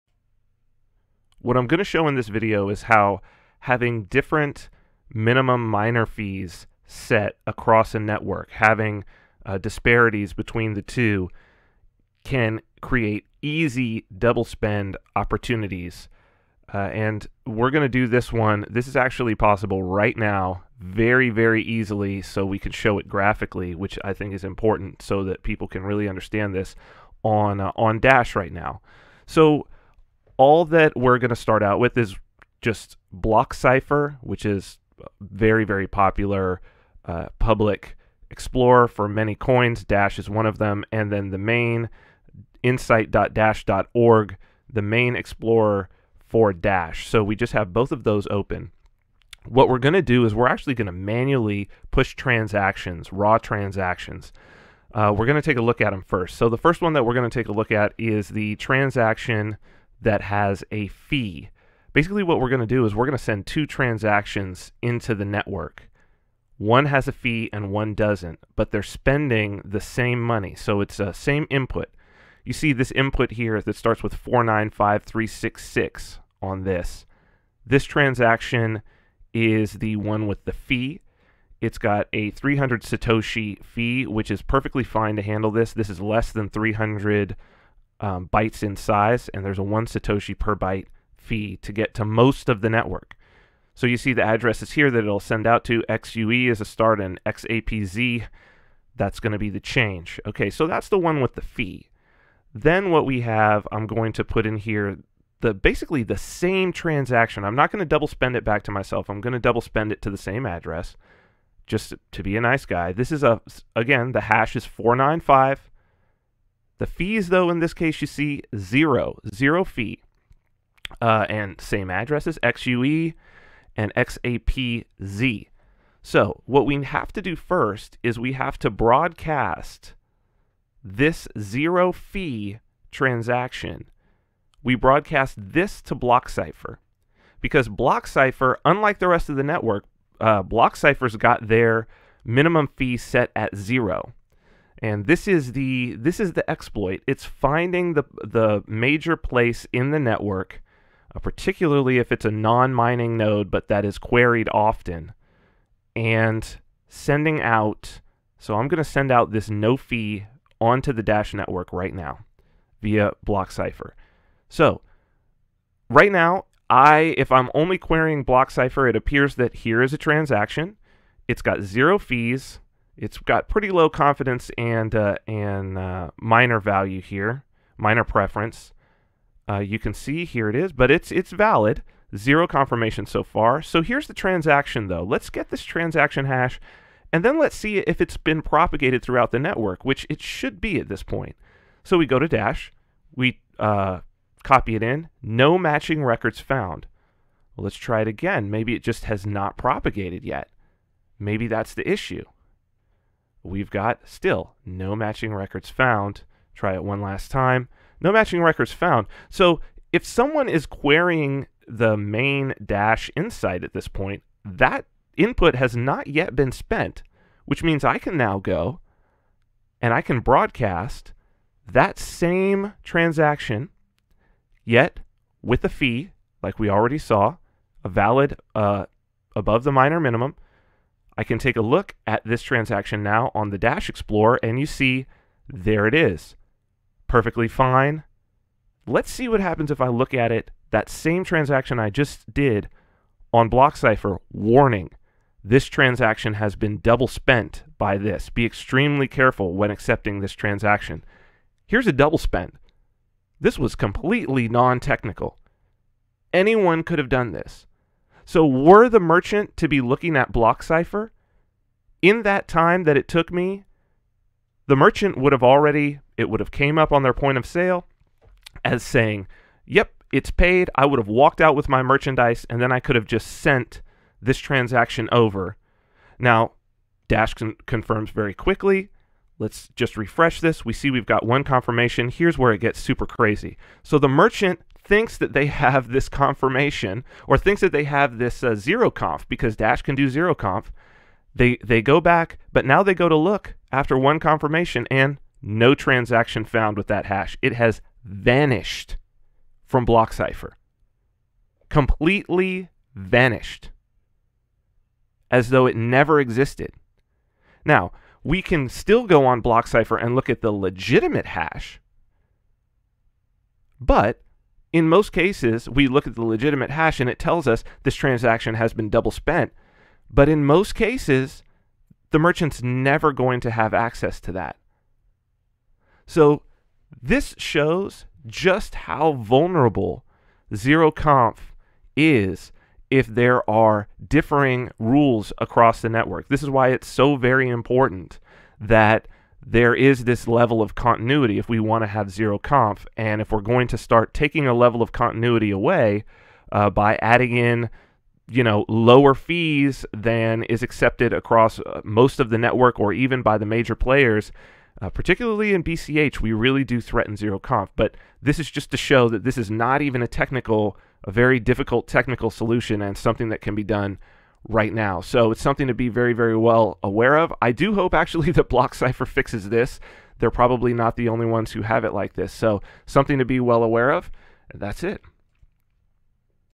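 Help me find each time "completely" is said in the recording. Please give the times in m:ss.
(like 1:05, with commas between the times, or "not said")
4:13, 5:01.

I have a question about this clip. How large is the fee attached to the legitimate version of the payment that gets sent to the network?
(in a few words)
300 Satoshi.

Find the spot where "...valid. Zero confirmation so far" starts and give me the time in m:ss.
3:01.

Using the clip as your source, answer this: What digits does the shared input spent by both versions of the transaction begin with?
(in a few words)
495366.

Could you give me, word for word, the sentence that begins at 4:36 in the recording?
Now, Dash con confirms very quickly.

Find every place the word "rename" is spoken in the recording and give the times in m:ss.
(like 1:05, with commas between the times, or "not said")
not said.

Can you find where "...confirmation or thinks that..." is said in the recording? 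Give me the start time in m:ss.
4:46.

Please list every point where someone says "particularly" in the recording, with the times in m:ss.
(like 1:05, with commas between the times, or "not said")
2:31, 5:54.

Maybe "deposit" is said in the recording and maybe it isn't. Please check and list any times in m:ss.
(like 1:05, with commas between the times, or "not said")
not said.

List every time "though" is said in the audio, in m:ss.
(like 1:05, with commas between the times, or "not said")
1:57, 3:04, 5:05.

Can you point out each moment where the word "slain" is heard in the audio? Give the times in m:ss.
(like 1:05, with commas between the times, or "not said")
not said.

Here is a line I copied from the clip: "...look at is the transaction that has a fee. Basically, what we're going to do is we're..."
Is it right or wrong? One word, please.
right.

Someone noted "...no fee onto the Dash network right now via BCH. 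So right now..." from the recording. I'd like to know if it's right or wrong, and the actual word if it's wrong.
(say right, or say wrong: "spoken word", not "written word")
wrong: "BlockCypher", not "BCH".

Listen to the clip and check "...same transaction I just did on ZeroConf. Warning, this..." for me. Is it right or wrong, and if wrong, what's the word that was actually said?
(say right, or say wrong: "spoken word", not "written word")
wrong: "BlockCypher", not "ZeroConf".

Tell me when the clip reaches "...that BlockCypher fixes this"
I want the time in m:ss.
6:08.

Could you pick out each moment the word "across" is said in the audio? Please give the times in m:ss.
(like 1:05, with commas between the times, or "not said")
0:07, 5:35, 5:51.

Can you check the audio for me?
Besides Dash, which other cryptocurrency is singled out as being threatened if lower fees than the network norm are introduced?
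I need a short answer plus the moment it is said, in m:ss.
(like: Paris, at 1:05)
BCH, at 5:55.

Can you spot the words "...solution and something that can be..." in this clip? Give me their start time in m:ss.
6:02.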